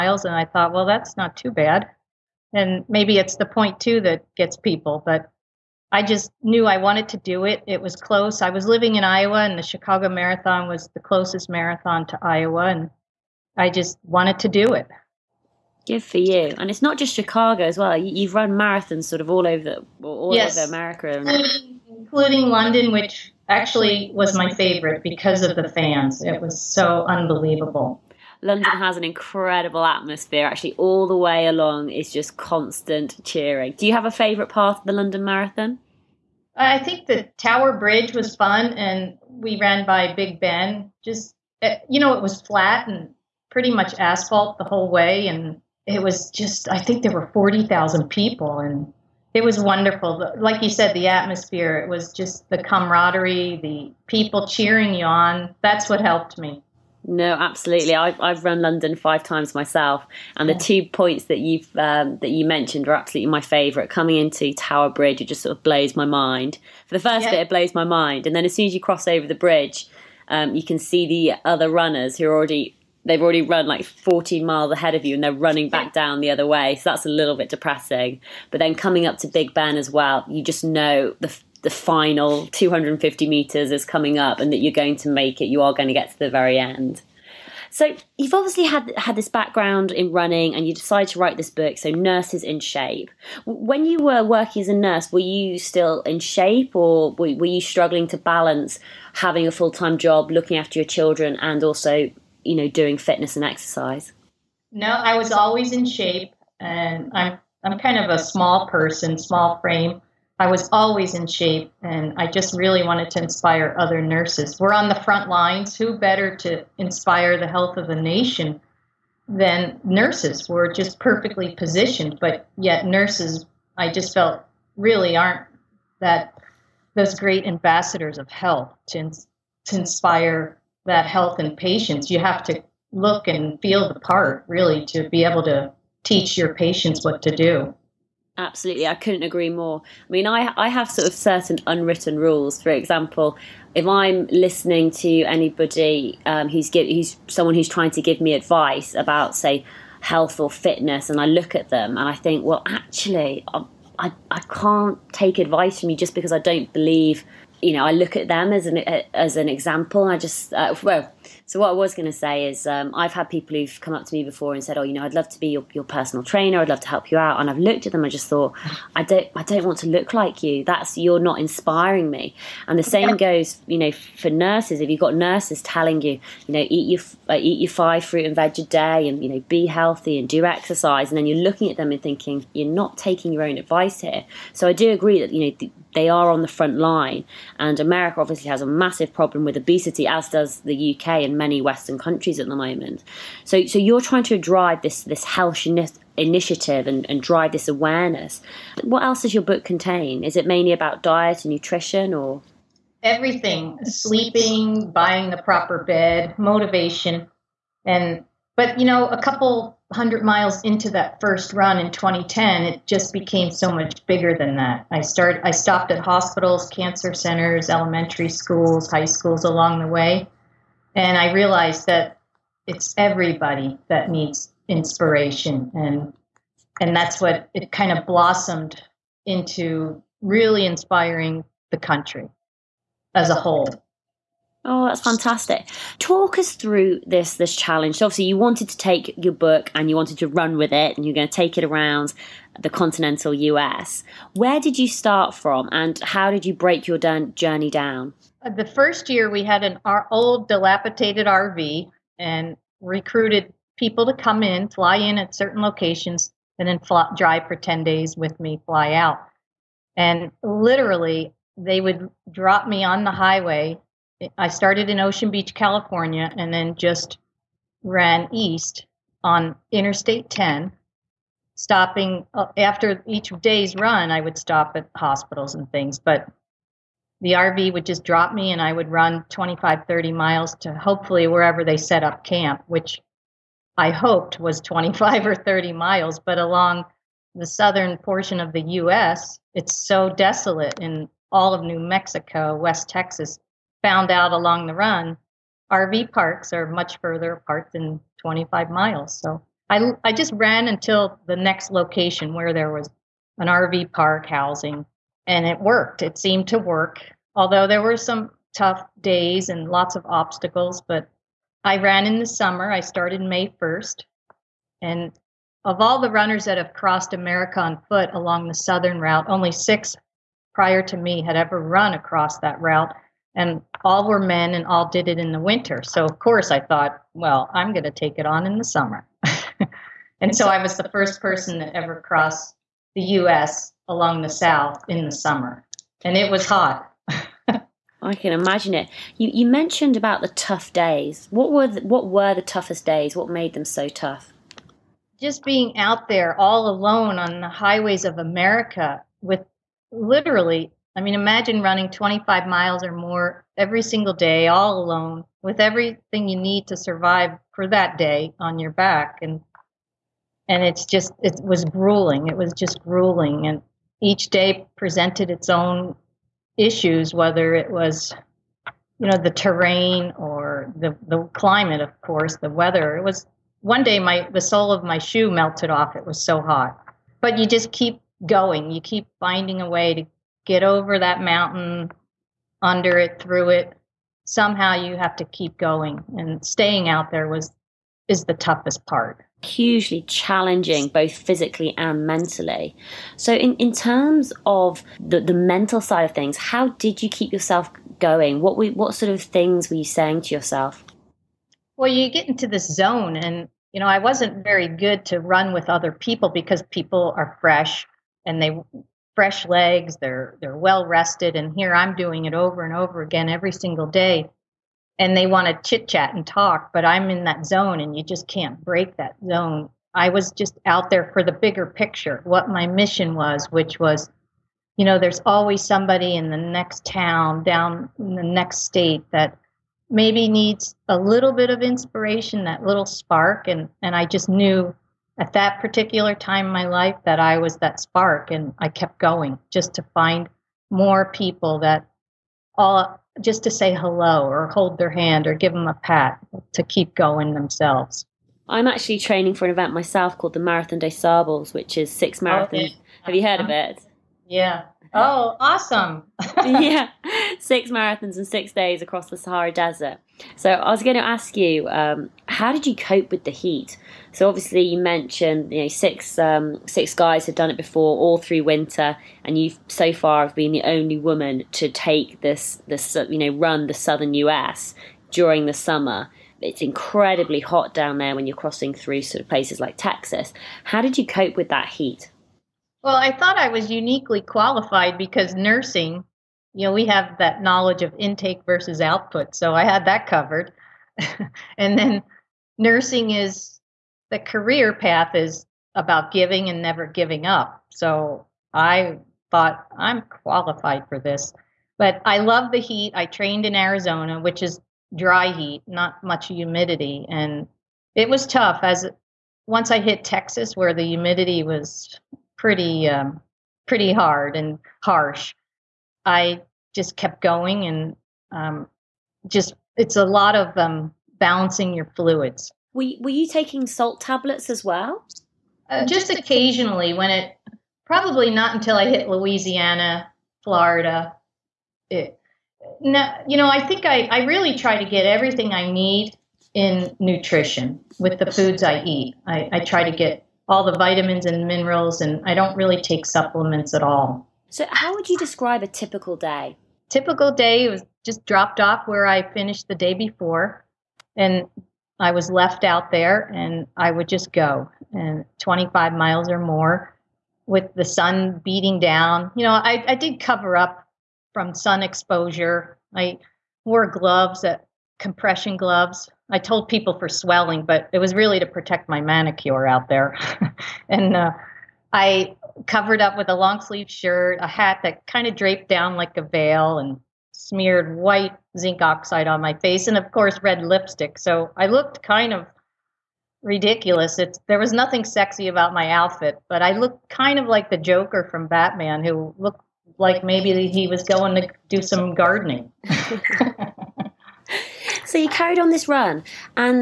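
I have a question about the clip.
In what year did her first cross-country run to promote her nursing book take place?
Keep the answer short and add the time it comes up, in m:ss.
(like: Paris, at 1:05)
2010, at 3:31.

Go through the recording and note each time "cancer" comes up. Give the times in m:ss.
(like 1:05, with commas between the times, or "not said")
3:36.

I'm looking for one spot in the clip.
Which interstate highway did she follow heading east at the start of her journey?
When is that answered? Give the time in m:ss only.
4:29.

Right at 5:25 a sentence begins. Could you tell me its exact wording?
So of course I thought, well, I'm going to take it on in the summer.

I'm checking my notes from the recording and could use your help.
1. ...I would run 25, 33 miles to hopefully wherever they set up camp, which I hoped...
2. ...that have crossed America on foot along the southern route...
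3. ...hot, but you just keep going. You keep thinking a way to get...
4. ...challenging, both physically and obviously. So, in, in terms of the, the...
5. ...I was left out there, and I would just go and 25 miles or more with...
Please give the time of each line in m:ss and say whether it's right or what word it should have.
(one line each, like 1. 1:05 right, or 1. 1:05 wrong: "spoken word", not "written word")
1. 4:38 wrong: "30", not "33"
2. 5:16 right
3. 6:16 wrong: "finding", not "thinking"
4. 6:30 wrong: "mentally", not "obviously"
5. 9:11 right.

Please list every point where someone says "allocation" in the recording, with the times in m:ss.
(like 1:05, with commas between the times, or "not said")
not said.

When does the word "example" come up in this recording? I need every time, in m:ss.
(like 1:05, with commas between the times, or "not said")
2:22, 2:39.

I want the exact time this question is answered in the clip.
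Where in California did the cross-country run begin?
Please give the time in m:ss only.
4:24.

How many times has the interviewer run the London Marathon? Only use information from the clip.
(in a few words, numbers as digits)
5.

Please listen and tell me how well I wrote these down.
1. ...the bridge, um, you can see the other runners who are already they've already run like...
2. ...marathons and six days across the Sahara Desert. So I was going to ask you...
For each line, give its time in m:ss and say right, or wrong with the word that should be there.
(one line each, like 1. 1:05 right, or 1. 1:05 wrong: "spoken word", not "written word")
1. 1:09 right
2. 7:37 right.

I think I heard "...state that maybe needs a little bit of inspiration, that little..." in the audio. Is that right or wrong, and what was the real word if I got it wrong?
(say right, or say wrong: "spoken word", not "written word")
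right.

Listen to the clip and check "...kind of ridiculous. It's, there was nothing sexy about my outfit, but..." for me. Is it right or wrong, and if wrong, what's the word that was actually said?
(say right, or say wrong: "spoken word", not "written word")
right.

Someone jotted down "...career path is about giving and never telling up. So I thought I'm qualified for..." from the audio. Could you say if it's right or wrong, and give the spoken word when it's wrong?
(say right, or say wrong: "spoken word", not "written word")
wrong: "giving", not "telling".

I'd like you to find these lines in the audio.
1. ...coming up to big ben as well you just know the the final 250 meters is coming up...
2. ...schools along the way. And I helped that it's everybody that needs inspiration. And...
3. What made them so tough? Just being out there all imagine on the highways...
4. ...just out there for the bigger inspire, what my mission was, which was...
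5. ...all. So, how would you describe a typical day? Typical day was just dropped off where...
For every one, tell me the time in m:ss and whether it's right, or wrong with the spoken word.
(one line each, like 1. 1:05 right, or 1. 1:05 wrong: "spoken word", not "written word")
1. 1:18 right
2. 3:39 wrong: "realized", not "helped"
3. 5:43 wrong: "alone", not "imagine"
4. 7:00 wrong: "picture", not "inspire"
5. 9:03 right.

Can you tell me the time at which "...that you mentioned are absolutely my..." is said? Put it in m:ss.
1:02.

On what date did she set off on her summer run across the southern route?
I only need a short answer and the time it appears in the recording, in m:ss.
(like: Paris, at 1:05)
May 1st, at 5:13.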